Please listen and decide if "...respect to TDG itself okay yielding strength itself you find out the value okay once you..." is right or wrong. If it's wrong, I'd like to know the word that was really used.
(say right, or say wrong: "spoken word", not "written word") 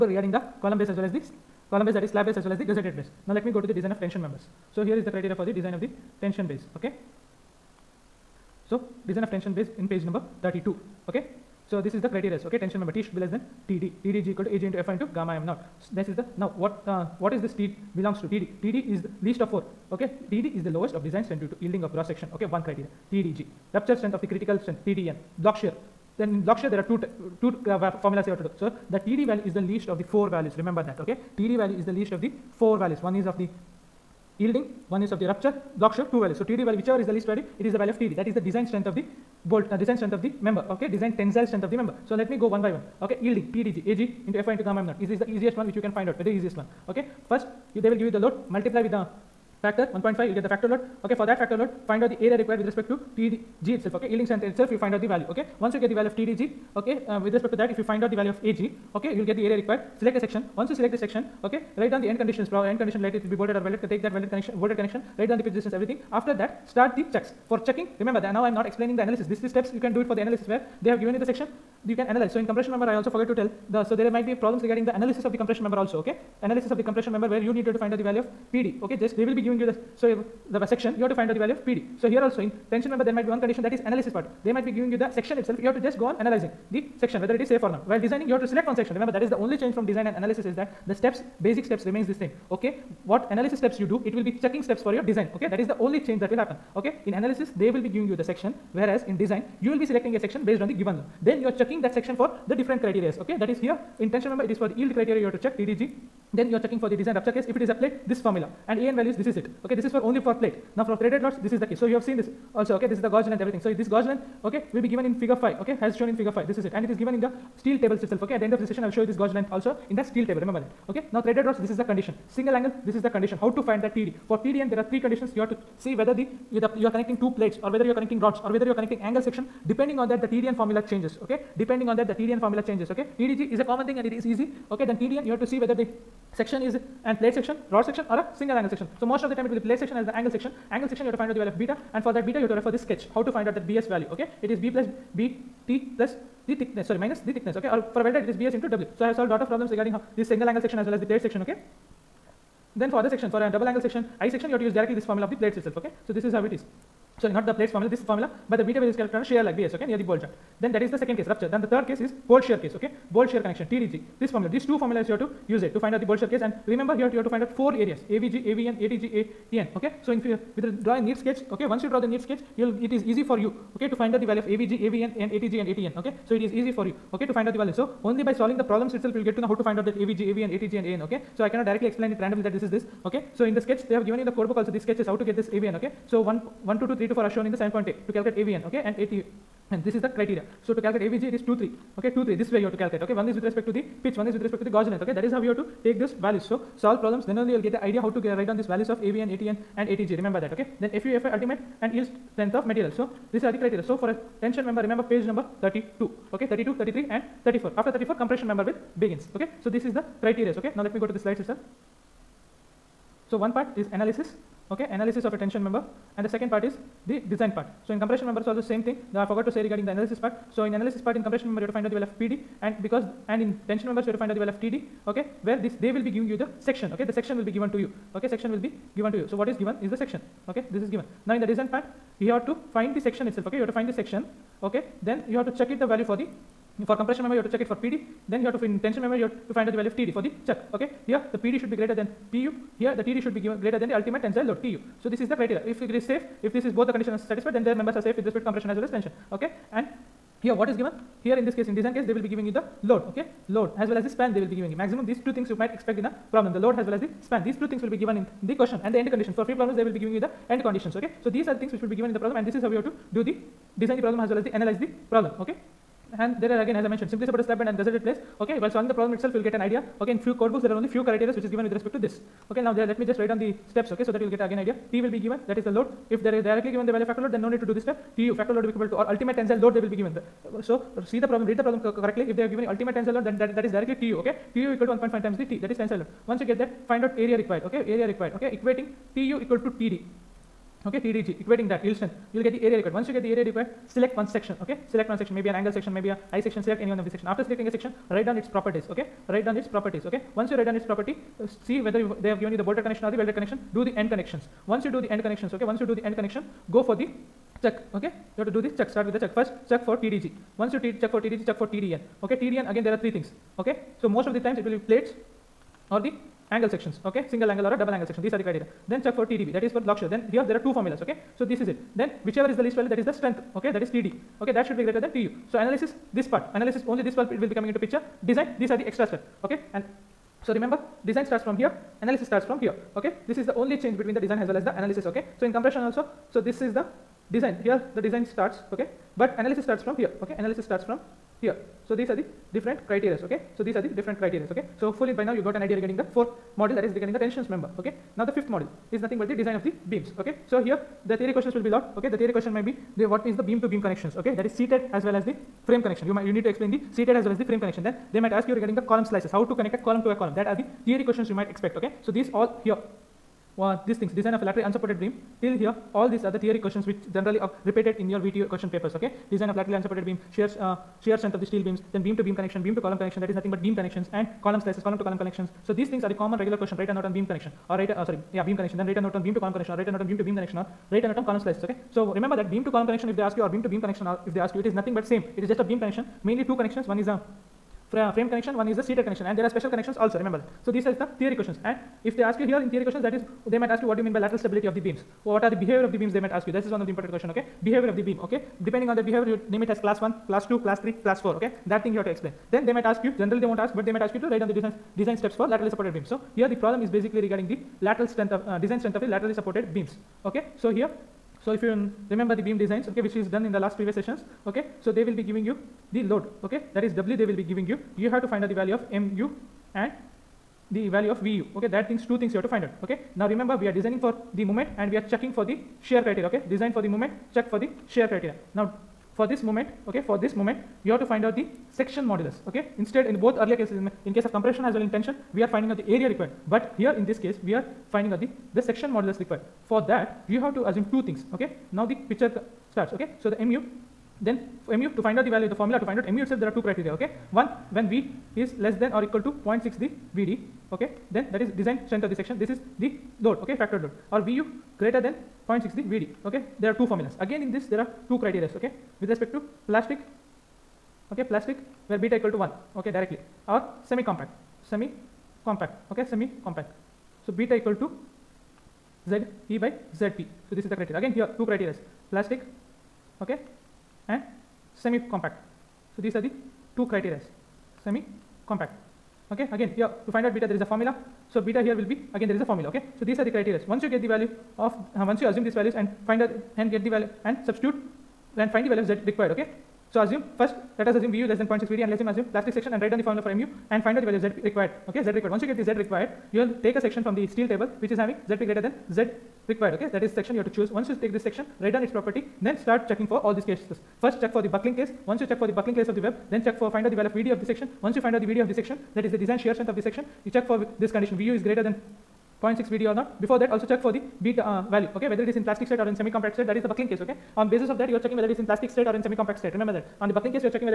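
right.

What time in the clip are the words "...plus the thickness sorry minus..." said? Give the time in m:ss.
2:25.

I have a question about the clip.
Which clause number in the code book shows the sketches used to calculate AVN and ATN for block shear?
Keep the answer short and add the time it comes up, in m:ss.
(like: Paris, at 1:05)
7.8, at 3:07.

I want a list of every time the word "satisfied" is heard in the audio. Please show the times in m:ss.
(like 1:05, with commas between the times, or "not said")
4:07.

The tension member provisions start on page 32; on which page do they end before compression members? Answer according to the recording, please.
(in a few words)
34.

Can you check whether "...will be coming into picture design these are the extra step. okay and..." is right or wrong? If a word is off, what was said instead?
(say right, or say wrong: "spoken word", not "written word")
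right.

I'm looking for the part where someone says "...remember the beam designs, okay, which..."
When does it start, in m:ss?
6:52.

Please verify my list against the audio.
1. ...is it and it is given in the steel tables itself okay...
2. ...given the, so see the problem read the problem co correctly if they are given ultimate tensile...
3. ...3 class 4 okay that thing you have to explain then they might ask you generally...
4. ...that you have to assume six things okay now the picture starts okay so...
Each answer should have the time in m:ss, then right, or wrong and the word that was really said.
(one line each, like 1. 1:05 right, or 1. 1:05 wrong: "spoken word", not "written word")
1. 1:56 right
2. 4:39 right
3. 6:40 right
4. 7:19 wrong: "two", not "six".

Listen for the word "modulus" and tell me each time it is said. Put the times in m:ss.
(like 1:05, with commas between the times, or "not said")
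7:12, 7:18.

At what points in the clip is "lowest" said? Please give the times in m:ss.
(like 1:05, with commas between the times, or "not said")
0:20.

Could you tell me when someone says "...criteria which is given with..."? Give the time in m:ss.
4:31.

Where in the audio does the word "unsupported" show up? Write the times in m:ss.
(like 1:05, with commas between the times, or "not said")
6:04, 6:09.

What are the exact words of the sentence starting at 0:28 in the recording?
So, the TD value is the least of the four values.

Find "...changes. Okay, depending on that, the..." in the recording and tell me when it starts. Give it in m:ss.
2:10.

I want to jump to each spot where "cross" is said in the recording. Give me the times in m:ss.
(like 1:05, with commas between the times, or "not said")
0:21.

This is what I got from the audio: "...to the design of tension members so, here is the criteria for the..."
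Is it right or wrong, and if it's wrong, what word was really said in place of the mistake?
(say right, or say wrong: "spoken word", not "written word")
right.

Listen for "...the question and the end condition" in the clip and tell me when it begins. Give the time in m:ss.
4:18.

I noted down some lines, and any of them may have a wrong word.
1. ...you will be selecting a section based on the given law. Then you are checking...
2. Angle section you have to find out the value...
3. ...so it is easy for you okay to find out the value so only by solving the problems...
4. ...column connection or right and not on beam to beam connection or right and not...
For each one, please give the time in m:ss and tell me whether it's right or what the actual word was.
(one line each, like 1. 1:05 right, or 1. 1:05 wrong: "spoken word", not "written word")
1. 1:39 right
2. 2:20 right
3. 2:56 right
4. 6:19 right.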